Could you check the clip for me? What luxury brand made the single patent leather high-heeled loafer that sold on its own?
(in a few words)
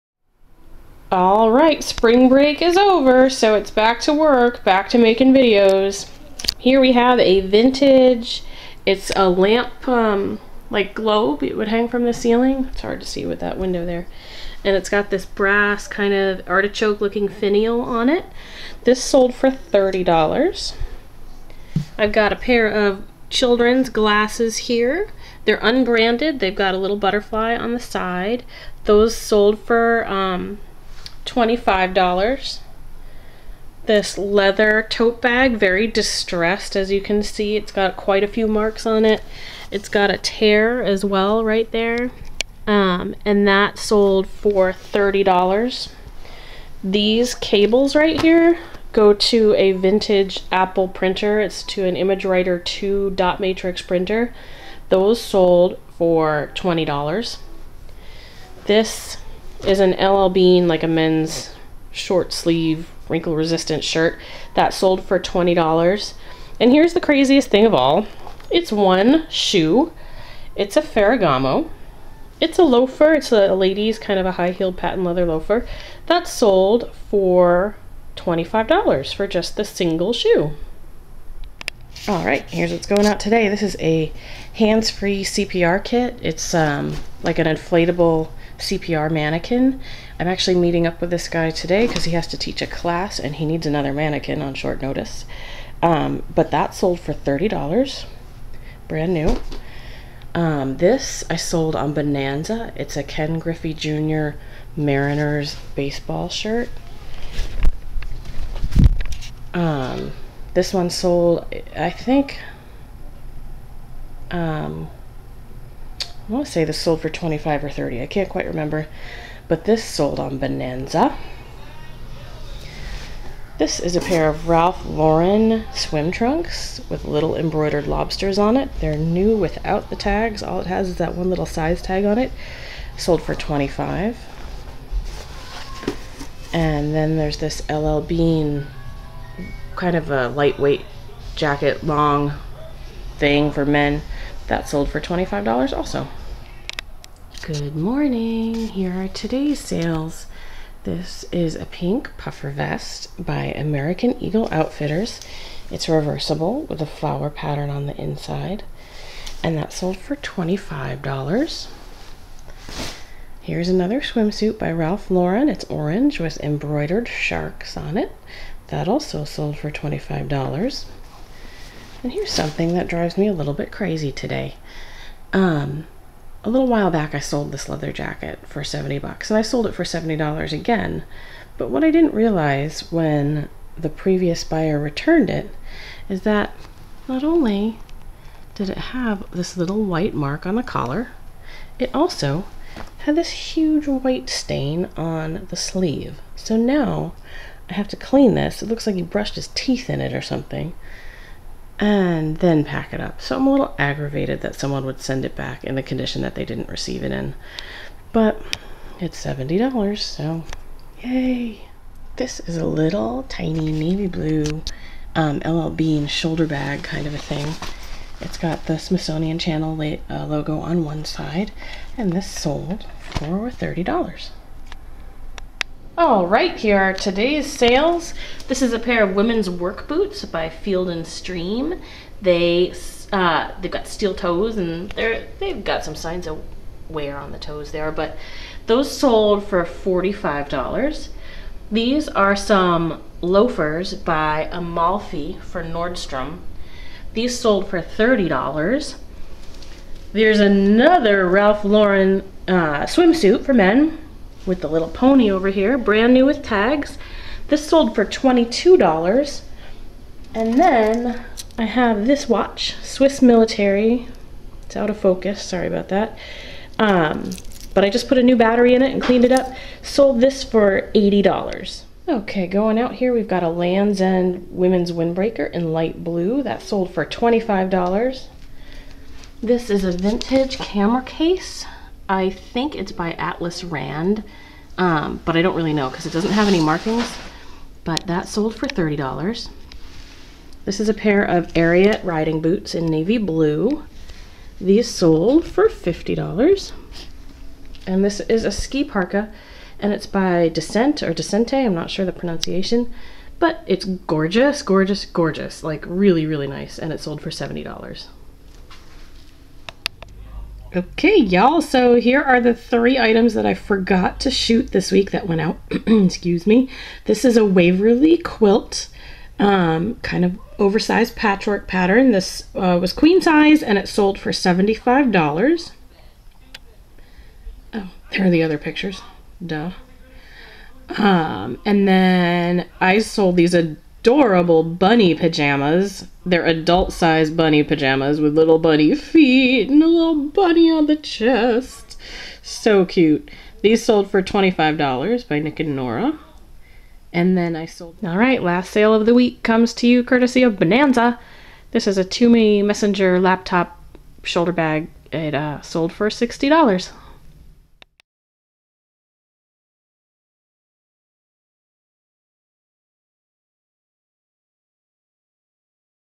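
Ferragamo.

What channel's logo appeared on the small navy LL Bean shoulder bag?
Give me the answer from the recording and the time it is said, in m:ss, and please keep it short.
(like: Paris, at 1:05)
Smithsonian Channel, at 3:38.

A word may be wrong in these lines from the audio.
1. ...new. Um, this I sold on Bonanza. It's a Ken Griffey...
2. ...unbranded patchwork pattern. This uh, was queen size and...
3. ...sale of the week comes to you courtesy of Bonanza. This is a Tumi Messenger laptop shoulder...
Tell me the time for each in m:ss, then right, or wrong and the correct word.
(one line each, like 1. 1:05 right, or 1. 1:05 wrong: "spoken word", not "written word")
1. 1:39 right
2. 5:20 wrong: "oversized", not "unbranded"
3. 5:48 right.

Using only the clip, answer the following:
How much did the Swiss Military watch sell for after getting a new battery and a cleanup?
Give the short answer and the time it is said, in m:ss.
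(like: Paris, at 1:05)
$80, at 4:30.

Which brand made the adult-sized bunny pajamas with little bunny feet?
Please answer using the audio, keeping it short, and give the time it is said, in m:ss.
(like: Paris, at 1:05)
Nick and Nora, at 5:45.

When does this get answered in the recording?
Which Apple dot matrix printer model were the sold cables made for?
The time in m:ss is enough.
0:51.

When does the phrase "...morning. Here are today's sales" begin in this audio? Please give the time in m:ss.
2:27.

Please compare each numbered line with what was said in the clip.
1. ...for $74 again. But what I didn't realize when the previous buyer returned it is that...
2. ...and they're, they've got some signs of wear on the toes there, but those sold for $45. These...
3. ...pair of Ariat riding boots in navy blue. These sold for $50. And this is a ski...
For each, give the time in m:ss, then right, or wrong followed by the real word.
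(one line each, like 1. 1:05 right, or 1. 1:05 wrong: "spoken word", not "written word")
1. 2:59 wrong: "70", not "74"
2. 3:54 right
3. 4:50 right.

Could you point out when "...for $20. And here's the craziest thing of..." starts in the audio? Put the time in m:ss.
1:05.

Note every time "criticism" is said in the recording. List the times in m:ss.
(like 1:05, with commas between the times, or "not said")
not said.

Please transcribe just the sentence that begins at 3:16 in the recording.
So now I have to clean this.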